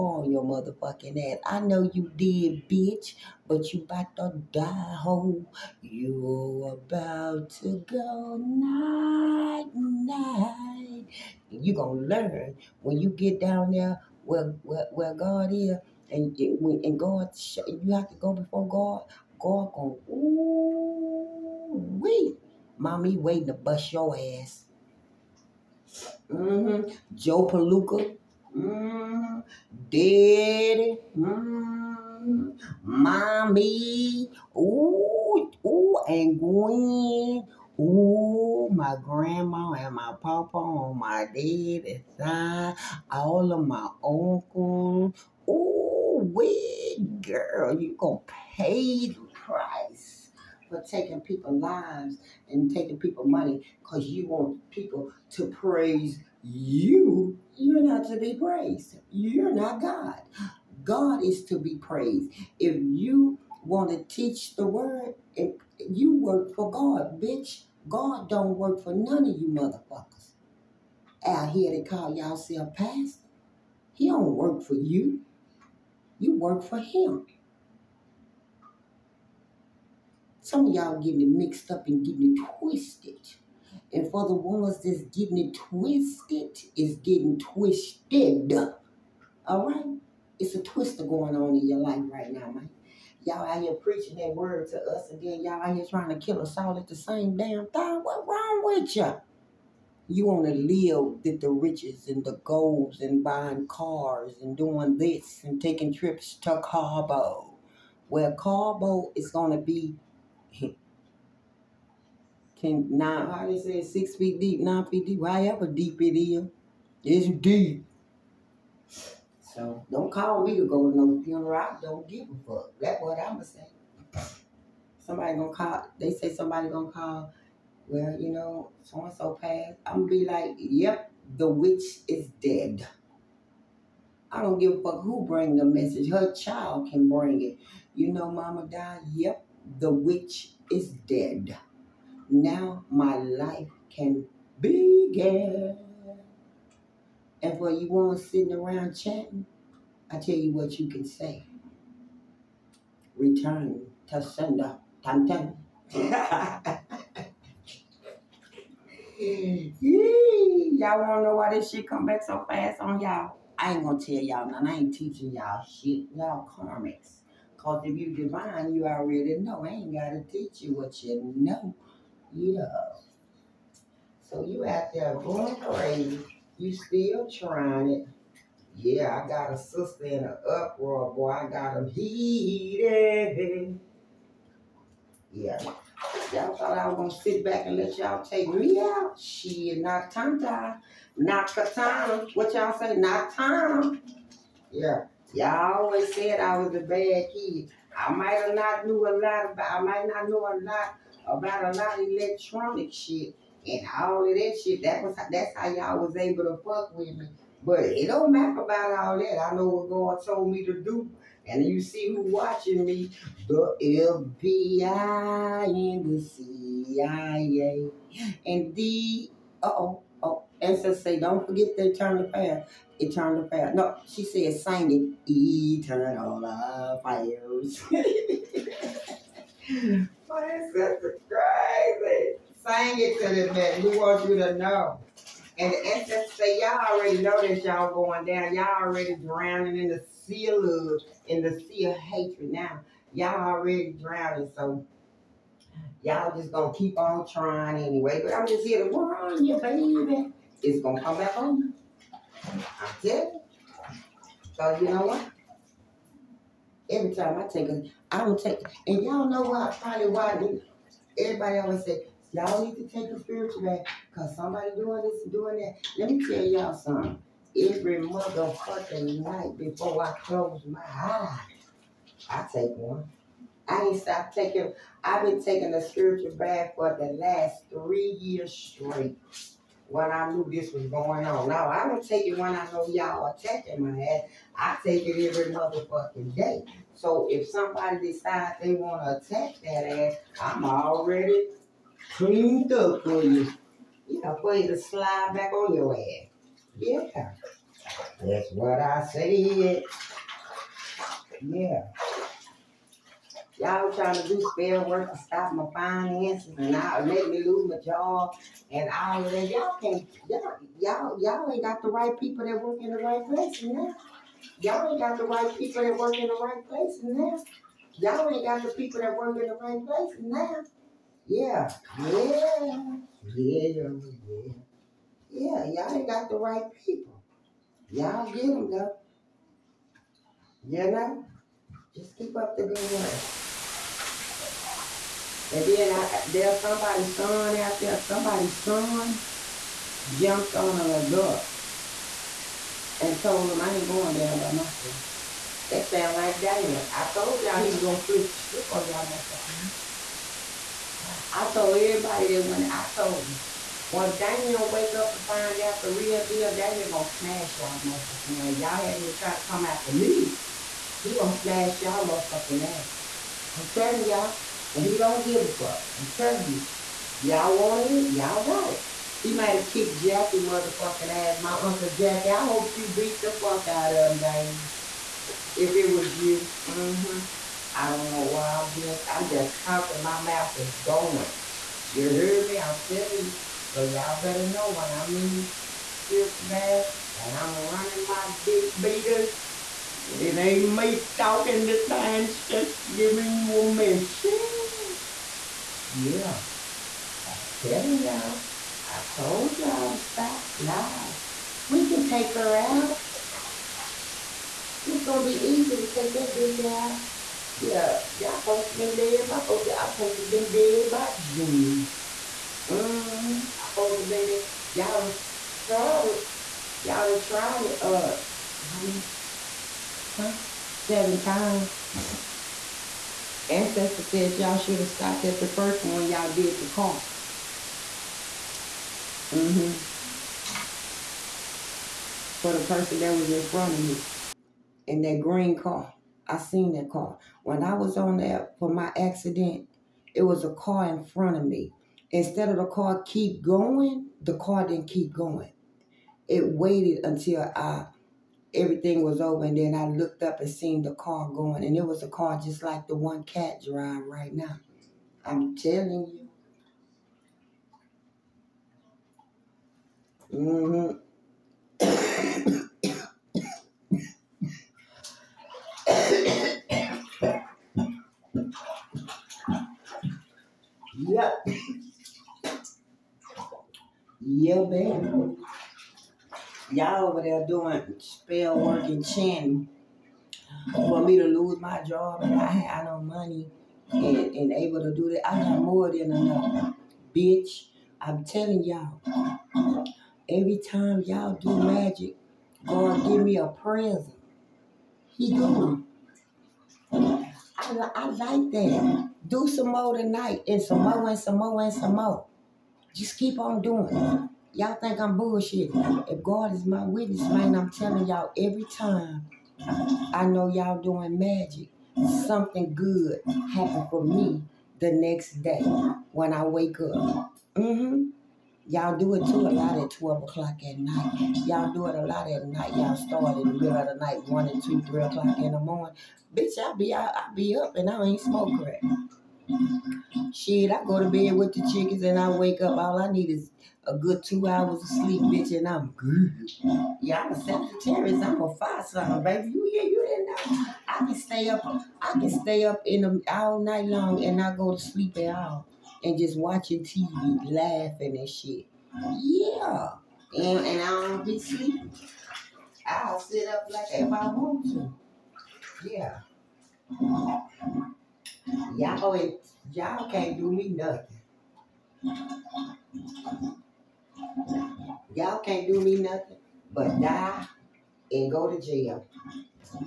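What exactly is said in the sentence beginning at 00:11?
You're going to learn when you get down there where, where, where God is.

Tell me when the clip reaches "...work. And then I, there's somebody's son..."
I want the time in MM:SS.
05:32.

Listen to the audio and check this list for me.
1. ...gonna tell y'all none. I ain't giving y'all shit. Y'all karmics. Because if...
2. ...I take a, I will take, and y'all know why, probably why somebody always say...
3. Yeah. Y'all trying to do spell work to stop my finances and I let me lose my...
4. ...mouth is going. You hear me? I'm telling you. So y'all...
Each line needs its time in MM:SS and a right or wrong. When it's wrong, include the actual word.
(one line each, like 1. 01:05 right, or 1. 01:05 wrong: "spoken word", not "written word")
1. 02:43 wrong: "teaching", not "giving"
2. 04:17 wrong: "everybody", not "somebody"
3. 05:01 right
4. 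06:20 right.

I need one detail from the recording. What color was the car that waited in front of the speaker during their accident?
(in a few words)
Green.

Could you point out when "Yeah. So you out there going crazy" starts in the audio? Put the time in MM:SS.
02:52.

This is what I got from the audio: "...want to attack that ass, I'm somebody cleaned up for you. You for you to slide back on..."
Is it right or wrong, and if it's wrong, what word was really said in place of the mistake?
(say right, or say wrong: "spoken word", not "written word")
wrong: "already", not "somebody".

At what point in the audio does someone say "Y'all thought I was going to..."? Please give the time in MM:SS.
03:06.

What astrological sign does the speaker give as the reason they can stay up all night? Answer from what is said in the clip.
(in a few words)
Sagittarius.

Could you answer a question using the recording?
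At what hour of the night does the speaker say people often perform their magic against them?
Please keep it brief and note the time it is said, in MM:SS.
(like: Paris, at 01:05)
12 o'clock, at 08:39.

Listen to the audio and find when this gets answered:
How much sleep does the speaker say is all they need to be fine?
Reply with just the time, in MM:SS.
08:54.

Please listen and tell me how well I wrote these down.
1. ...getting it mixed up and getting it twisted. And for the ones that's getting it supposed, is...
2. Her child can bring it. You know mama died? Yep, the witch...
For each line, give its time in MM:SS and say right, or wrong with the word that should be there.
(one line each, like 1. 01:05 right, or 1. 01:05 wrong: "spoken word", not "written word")
1. 01:21 wrong: "twisted", not "supposed"
2. 02:16 right.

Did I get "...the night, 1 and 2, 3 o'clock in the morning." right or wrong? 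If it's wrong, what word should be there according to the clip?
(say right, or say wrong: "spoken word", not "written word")
right.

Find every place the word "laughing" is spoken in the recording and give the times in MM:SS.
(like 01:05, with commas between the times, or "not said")
09:07.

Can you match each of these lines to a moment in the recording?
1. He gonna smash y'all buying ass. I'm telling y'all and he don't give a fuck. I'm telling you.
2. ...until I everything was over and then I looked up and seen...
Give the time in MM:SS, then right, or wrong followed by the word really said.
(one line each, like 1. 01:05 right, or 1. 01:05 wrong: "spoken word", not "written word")
1. 06:00 wrong: "motherfucking", not "buying"
2. 07:27 right.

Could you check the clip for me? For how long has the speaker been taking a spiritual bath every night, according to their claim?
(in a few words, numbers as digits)
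3 years.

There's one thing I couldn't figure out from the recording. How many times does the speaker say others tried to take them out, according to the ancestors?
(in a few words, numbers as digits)
7.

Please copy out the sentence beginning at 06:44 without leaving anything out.
It's gonna be easy to take that bitch out.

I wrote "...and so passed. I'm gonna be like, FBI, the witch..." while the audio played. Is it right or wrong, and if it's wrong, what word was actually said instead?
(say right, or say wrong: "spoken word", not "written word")
wrong: "Yep", not "FBI".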